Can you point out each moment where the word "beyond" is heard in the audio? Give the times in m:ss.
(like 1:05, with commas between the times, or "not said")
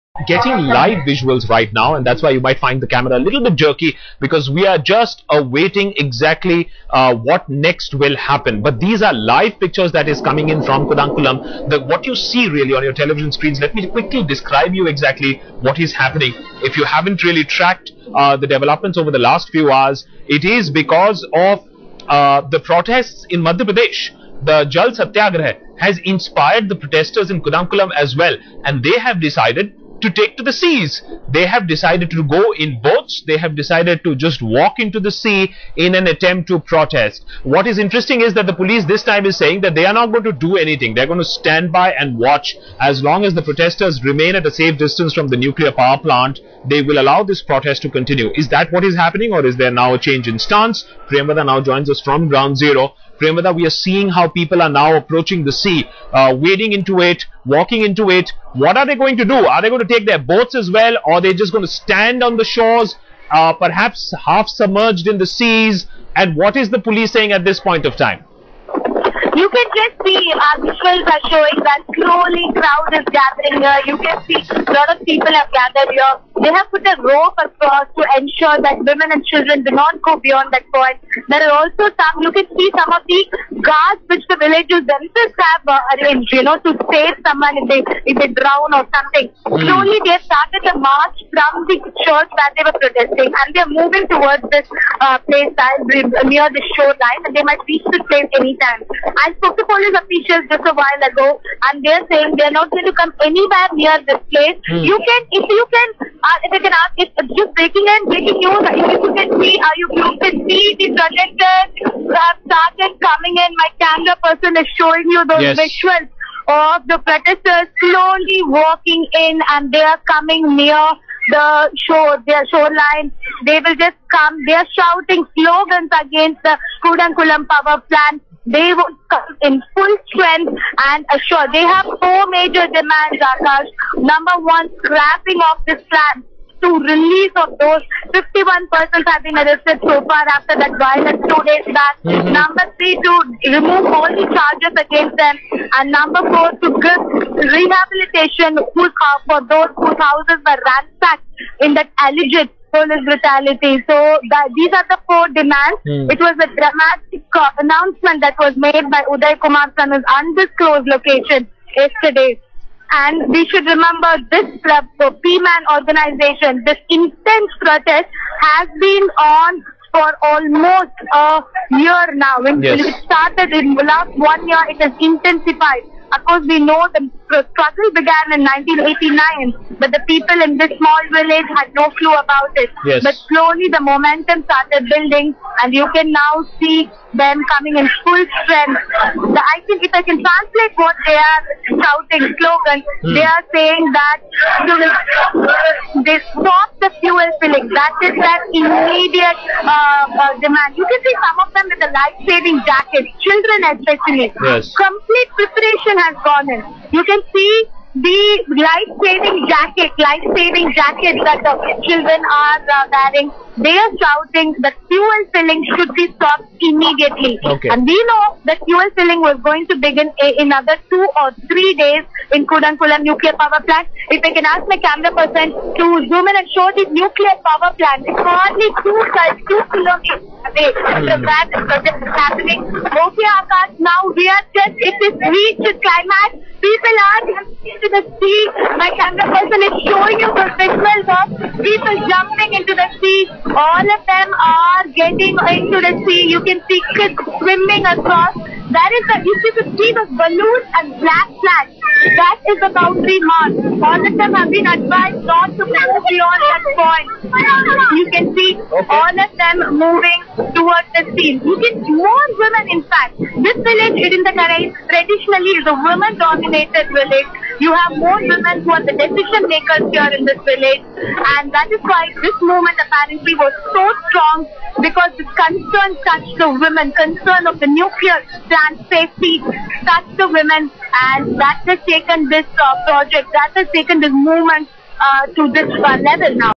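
1:20, 4:16.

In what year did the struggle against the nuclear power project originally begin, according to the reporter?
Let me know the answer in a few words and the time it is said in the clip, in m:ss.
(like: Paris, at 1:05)
1989, at 2:58.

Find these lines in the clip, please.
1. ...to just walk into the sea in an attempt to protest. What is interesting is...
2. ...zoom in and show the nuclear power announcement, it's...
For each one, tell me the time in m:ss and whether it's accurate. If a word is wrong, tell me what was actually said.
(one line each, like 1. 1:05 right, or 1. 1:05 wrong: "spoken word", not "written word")
1. 0:34 right
2. 3:46 wrong: "plant", not "announcement".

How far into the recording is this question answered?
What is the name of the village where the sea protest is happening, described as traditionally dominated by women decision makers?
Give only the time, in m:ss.
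4:24.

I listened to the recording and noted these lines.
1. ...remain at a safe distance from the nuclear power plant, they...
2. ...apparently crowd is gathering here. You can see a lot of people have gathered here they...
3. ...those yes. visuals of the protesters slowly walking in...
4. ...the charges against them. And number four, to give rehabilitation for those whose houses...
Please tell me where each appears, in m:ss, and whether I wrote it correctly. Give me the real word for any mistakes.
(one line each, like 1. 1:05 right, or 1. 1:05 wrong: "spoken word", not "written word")
1. 0:44 right
2. 1:11 wrong: "slowly", not "apparently"
3. 1:55 right
4. 2:24 right.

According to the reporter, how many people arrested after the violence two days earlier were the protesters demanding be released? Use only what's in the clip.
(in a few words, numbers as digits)
51.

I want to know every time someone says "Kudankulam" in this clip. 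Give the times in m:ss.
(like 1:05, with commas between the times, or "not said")
0:10, 0:27, 2:06, 3:42.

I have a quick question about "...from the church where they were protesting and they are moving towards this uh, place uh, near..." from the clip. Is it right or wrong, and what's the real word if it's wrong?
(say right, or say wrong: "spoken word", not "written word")
right.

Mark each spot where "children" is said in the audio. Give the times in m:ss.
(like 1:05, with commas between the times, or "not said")
1:19, 3:23, 3:31.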